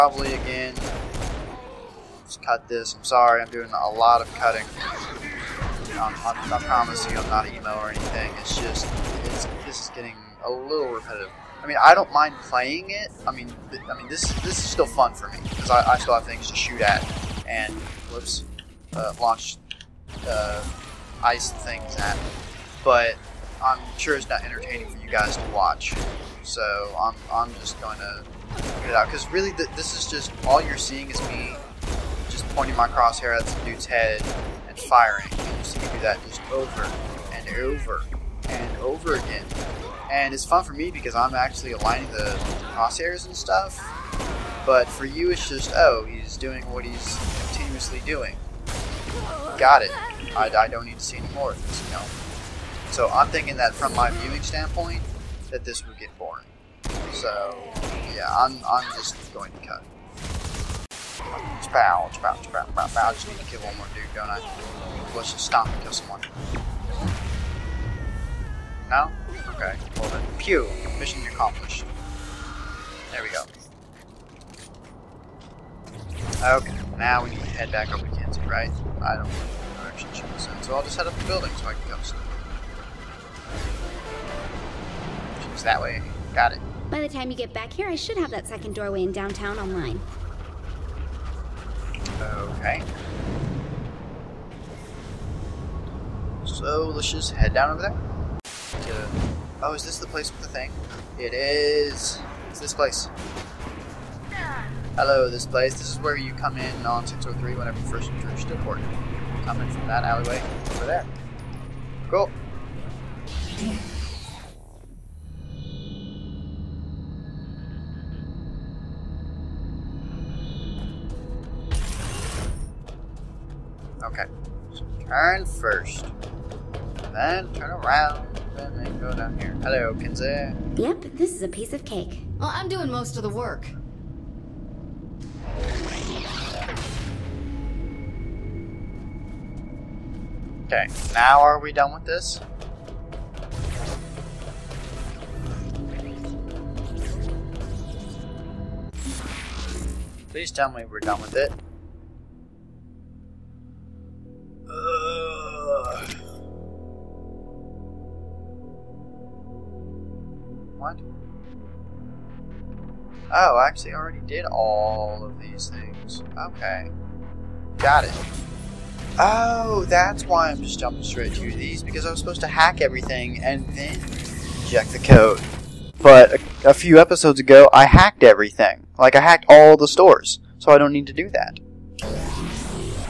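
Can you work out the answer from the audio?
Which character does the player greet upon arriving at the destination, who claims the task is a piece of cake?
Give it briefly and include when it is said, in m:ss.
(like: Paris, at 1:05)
Kinzie, at 2:09.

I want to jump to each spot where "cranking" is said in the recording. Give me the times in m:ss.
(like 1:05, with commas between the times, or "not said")
not said.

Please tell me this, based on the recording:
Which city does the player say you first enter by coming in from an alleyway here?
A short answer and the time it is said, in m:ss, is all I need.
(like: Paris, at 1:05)
Steelport, at 1:48.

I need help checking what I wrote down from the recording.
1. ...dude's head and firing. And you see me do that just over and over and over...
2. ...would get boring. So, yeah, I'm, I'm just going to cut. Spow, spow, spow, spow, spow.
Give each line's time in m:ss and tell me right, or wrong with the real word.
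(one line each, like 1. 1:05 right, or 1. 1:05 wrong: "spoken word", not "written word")
1. 0:33 right
2. 0:55 right.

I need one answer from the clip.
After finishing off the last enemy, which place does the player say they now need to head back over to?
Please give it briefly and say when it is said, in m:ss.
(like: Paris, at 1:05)
Kansas, at 1:18.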